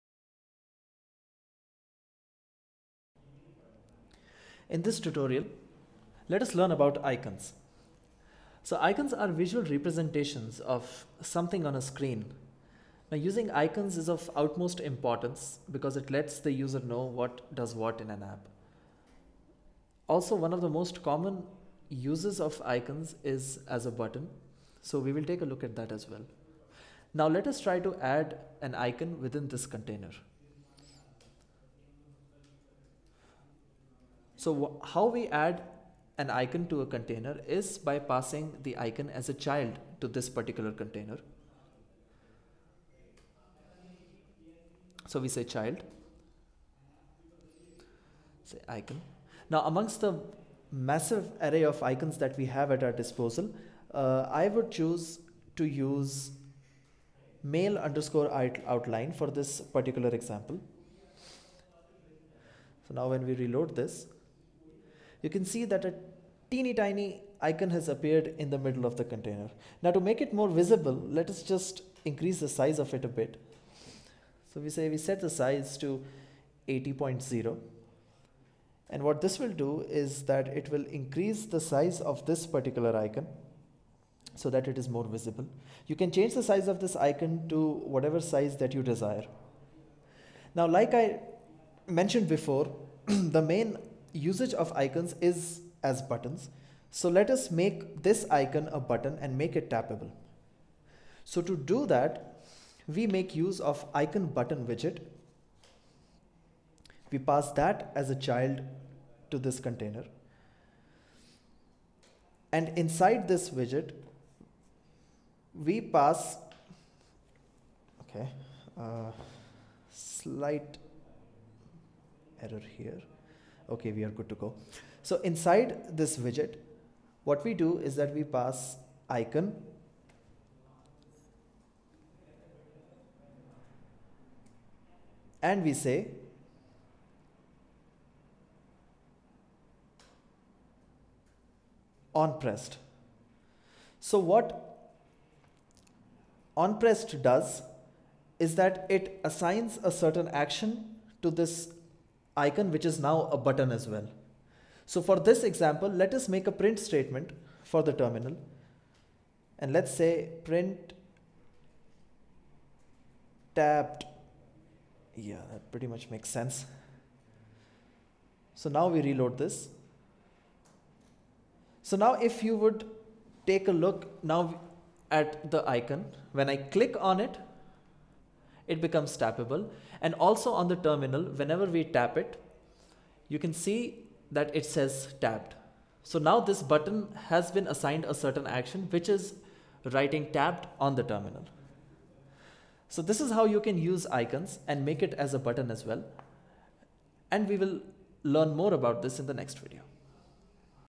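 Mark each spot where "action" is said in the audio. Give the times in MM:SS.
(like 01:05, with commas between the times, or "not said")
02:30, 03:08.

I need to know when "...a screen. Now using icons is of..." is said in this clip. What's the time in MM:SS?
00:11.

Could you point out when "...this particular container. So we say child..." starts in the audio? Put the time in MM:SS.
00:40.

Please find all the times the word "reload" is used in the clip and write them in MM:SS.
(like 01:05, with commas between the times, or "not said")
01:03, 02:49.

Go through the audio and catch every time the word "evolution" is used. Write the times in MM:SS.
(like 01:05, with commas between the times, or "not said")
not said.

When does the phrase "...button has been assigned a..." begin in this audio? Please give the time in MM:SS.
03:06.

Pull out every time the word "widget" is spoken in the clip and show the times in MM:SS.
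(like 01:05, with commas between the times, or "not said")
01:44, 01:53, 02:06.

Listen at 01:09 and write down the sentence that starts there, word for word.
Now to make it more visible, let us just increase the size of it a bit.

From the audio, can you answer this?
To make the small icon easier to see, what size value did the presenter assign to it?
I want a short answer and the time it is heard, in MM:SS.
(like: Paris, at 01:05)
80.0, at 01:16.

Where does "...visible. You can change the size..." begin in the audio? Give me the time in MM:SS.
01:25.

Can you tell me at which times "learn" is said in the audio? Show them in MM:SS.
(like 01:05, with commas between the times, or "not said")
00:06, 03:18.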